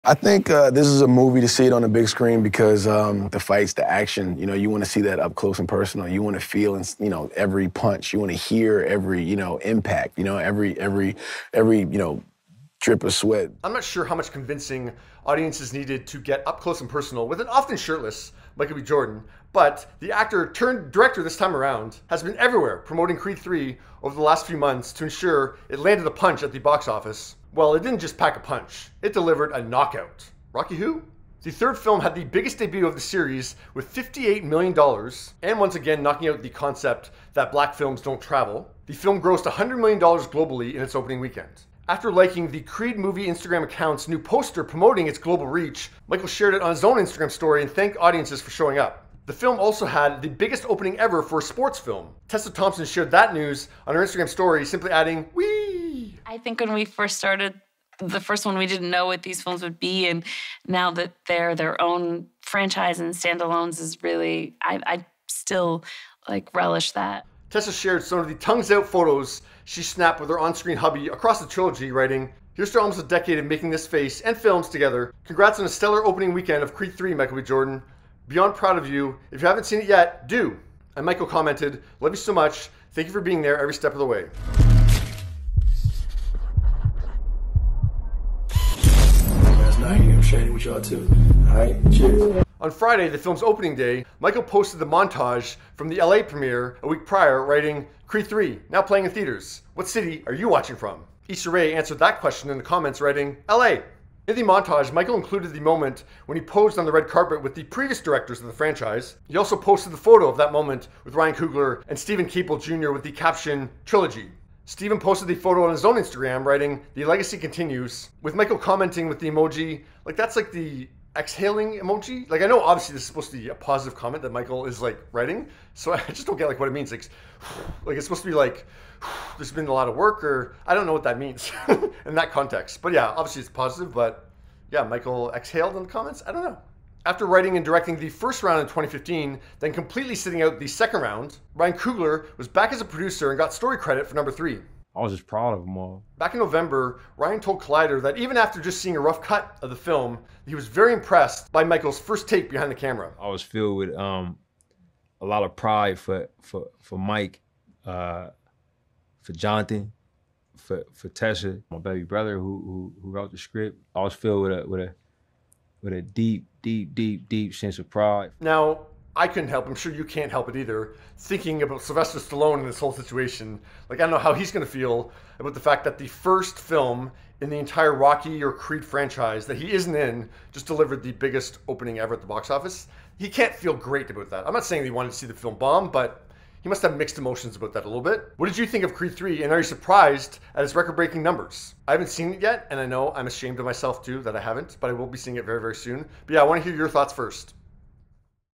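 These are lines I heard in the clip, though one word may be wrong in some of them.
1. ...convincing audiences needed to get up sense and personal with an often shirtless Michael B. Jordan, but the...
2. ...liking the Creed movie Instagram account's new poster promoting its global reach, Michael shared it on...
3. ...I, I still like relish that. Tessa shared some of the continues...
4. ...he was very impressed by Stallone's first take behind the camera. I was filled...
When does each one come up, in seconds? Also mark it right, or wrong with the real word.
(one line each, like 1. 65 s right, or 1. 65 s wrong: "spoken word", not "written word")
1. 14 s wrong: "close", not "sense"
2. 42 s right
3. 64 s wrong: "tongues", not "continues"
4. 150 s wrong: "Michael", not "Stallone".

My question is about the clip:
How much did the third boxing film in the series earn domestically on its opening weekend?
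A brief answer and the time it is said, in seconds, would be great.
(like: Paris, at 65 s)
$58 million, at 33 s.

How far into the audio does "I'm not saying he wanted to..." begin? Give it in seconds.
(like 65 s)
184 s.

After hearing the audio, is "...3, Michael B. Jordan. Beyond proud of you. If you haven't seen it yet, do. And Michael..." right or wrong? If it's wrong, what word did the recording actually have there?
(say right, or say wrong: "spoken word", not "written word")
right.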